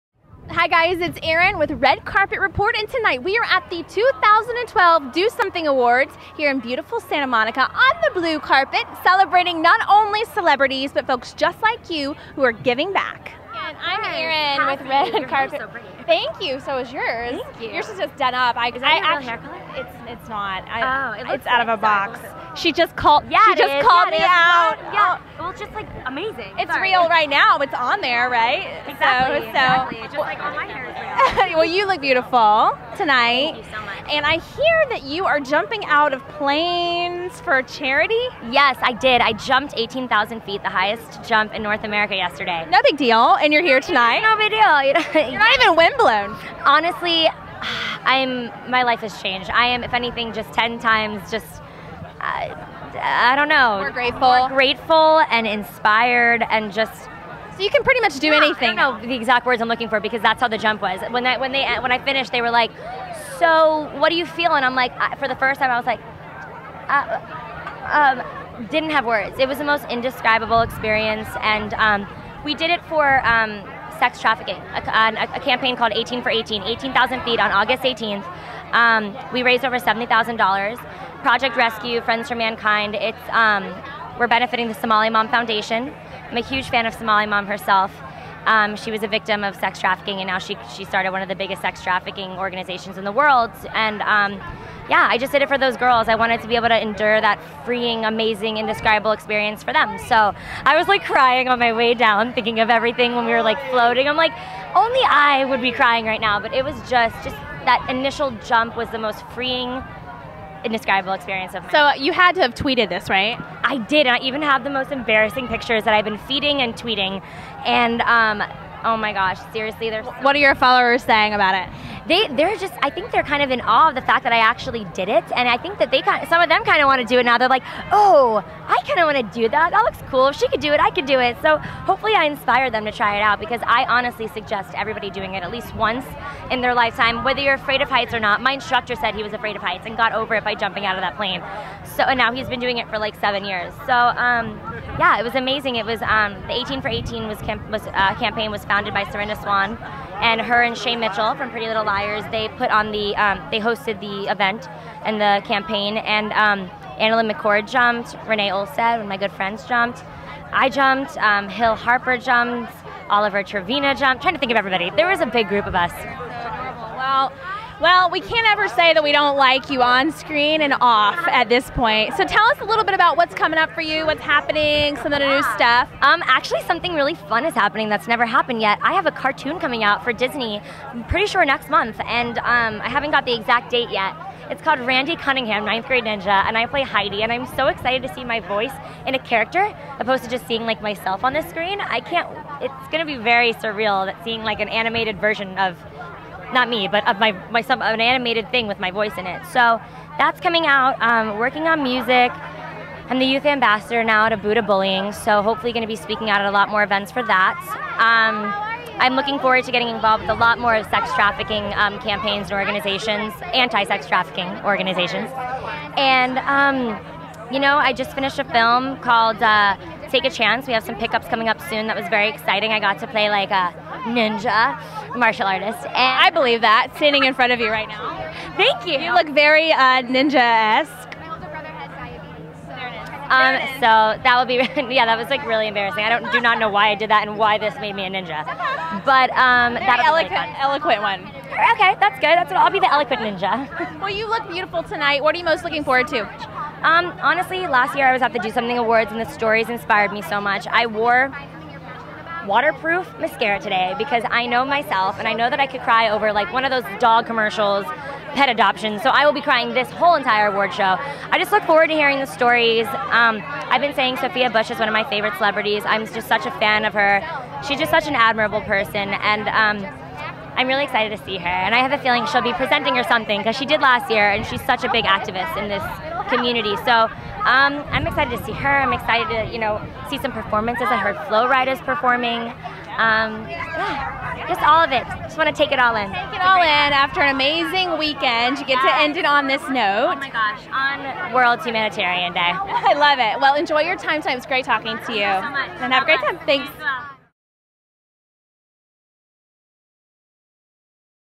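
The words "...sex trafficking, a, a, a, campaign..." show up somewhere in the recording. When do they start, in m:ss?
1:13.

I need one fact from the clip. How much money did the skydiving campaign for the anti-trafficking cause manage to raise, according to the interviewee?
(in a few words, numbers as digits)
over $70,000.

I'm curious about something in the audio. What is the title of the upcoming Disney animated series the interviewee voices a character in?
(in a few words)
Randy Cunningham, Ninth Grade Ninja.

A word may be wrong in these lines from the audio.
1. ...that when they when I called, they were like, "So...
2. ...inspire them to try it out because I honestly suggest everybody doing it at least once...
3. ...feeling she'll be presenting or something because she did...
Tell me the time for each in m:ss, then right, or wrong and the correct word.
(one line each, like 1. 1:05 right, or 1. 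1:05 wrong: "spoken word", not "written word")
1. 1:01 wrong: "finished", not "called"
2. 2:12 right
3. 4:32 right.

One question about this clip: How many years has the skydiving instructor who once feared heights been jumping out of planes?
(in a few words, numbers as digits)
7 years.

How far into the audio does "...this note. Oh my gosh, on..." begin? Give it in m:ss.
4:49.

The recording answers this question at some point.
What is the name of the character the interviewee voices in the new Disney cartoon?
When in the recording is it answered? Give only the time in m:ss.
3:06.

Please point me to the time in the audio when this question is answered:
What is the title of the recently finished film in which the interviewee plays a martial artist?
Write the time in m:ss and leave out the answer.
3:40.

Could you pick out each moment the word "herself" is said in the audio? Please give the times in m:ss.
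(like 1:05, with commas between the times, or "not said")
1:27.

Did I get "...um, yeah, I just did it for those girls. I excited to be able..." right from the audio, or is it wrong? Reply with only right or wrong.
wrong.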